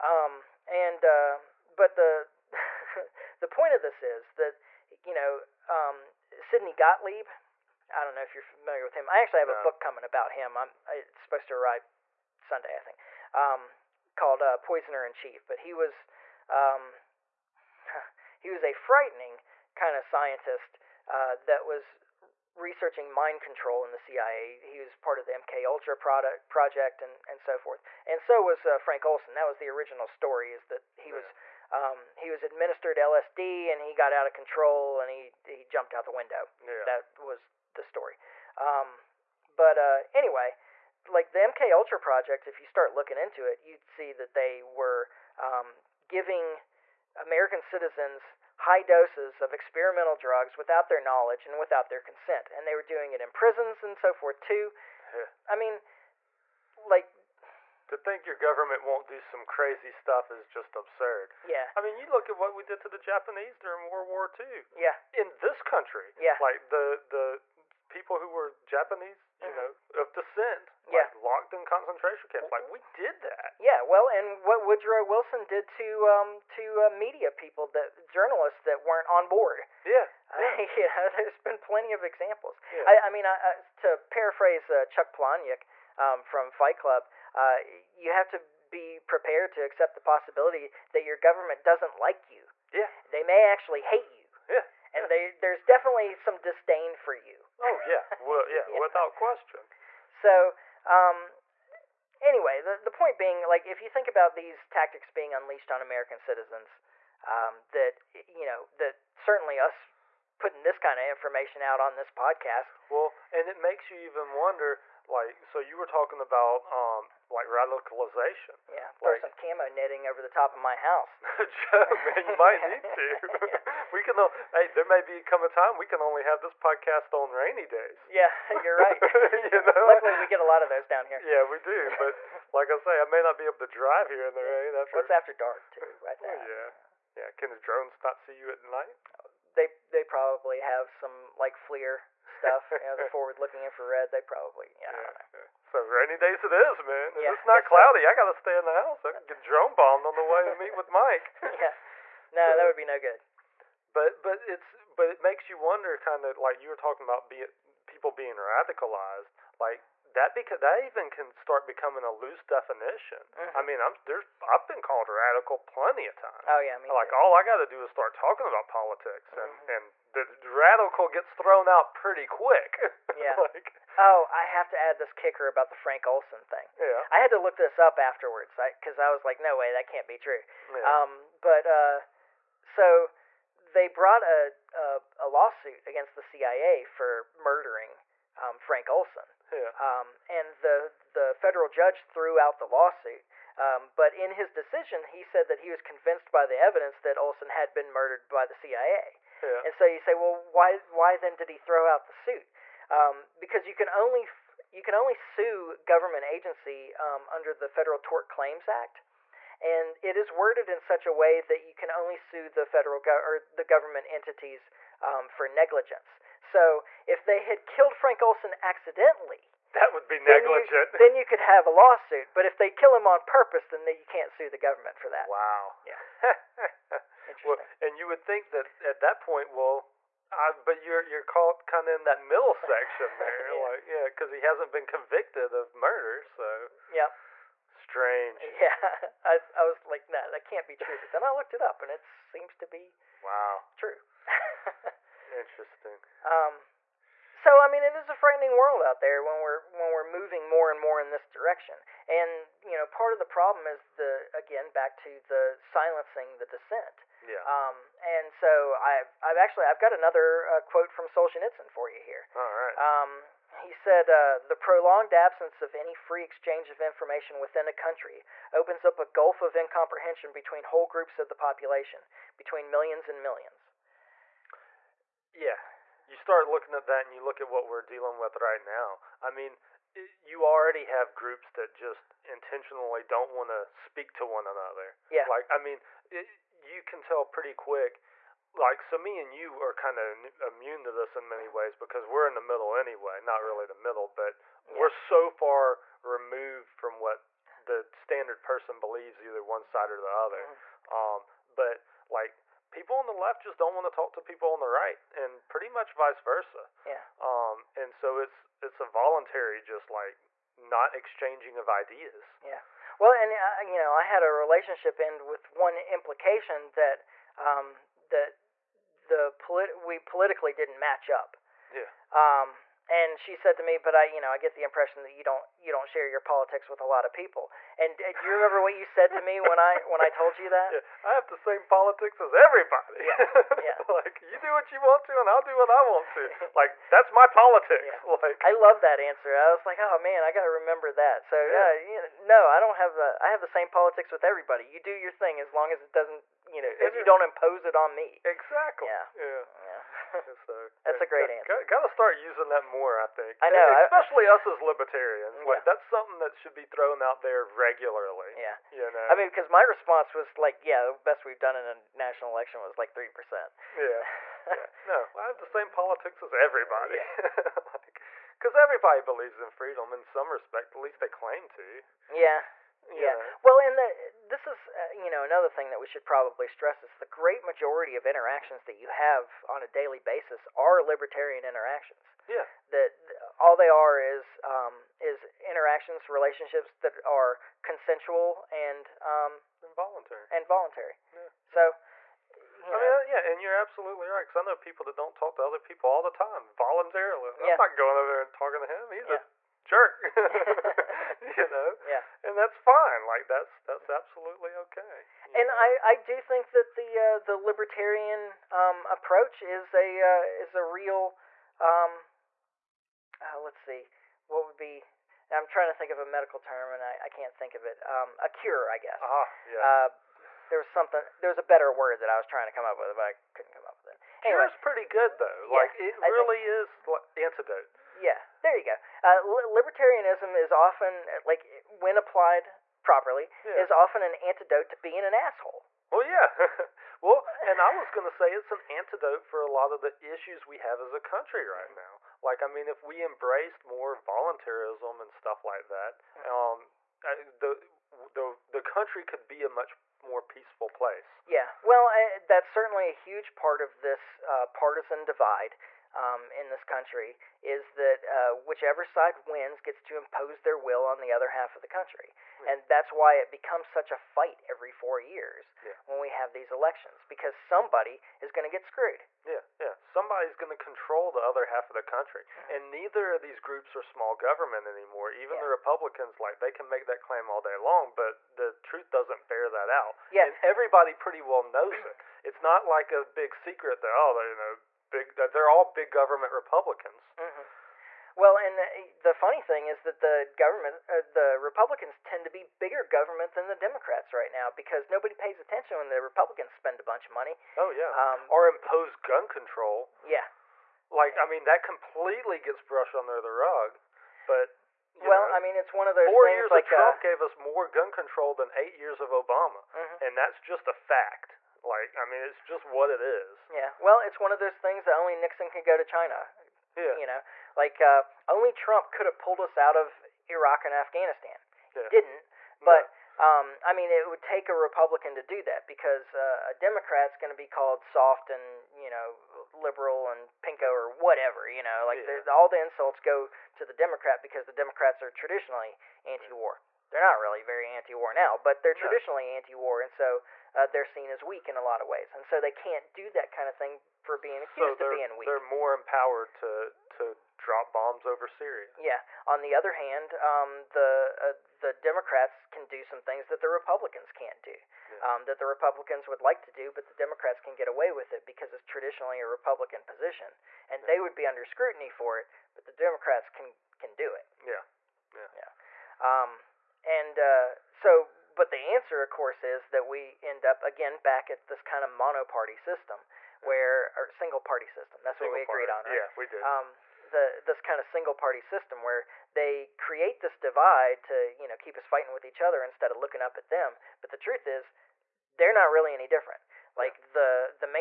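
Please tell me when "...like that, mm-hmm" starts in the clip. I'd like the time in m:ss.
7:25.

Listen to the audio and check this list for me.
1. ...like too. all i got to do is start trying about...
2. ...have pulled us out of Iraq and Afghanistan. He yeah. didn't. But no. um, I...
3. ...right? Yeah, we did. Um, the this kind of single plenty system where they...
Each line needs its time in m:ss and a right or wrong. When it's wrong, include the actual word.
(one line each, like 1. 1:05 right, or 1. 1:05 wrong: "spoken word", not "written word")
1. 2:46 wrong: "talking", not "trying"
2. 8:39 right
3. 9:35 wrong: "party", not "plenty".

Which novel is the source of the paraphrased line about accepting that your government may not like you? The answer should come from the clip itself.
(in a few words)
Fight Club.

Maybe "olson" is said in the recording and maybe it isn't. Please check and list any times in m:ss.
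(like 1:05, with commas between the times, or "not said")
0:29, 2:56, 3:08, 3:17, 3:38.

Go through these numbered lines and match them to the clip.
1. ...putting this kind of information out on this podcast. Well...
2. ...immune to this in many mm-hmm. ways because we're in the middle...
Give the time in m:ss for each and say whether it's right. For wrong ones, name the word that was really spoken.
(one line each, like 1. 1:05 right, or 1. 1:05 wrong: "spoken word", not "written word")
1. 1:50 right
2. 4:50 right.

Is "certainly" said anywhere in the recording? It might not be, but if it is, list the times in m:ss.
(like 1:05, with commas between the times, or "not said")
1:49, 7:32.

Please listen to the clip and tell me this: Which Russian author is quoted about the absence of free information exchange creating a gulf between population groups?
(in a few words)
Solzhenitsyn.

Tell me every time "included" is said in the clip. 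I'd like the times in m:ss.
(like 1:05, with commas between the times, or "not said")
not said.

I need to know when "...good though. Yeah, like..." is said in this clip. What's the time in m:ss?
7:04.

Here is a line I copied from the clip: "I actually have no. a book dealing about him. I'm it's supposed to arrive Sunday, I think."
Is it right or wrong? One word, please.
wrong.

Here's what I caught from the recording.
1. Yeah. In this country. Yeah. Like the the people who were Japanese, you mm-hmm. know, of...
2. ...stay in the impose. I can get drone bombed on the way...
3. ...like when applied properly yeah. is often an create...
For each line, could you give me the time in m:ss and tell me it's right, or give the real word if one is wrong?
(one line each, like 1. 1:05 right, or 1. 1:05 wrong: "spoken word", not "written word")
1. 1:04 right
2. 2:28 wrong: "house", not "impose"
3. 7:11 wrong: "antidote", not "create".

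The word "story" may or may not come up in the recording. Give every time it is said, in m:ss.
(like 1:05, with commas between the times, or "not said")
0:30, 0:37.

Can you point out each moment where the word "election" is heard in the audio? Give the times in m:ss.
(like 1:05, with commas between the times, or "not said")
6:02, 7:46.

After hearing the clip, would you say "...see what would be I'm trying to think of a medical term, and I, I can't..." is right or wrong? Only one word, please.
right.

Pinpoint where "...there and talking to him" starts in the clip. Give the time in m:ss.
6:38.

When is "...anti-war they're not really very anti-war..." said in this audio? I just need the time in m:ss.
8:56.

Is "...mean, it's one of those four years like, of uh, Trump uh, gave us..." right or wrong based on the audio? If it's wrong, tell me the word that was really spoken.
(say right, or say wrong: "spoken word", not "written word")
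right.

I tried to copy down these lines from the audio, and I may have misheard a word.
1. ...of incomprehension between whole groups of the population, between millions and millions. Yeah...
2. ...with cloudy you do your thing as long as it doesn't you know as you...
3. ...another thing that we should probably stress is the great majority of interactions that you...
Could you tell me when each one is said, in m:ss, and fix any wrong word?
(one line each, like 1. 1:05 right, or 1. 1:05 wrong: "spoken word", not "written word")
1. 4:29 right
2. 5:44 wrong: "everybody", not "cloudy"
3. 6:15 right.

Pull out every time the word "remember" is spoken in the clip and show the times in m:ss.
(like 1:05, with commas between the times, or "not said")
5:28, 5:40.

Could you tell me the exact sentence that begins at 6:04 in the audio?
No, I have the same politics as everybody.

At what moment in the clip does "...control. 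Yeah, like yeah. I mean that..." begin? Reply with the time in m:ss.
8:19.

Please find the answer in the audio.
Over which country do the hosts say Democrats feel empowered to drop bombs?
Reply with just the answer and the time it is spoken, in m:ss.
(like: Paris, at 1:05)
Syria, at 9:08.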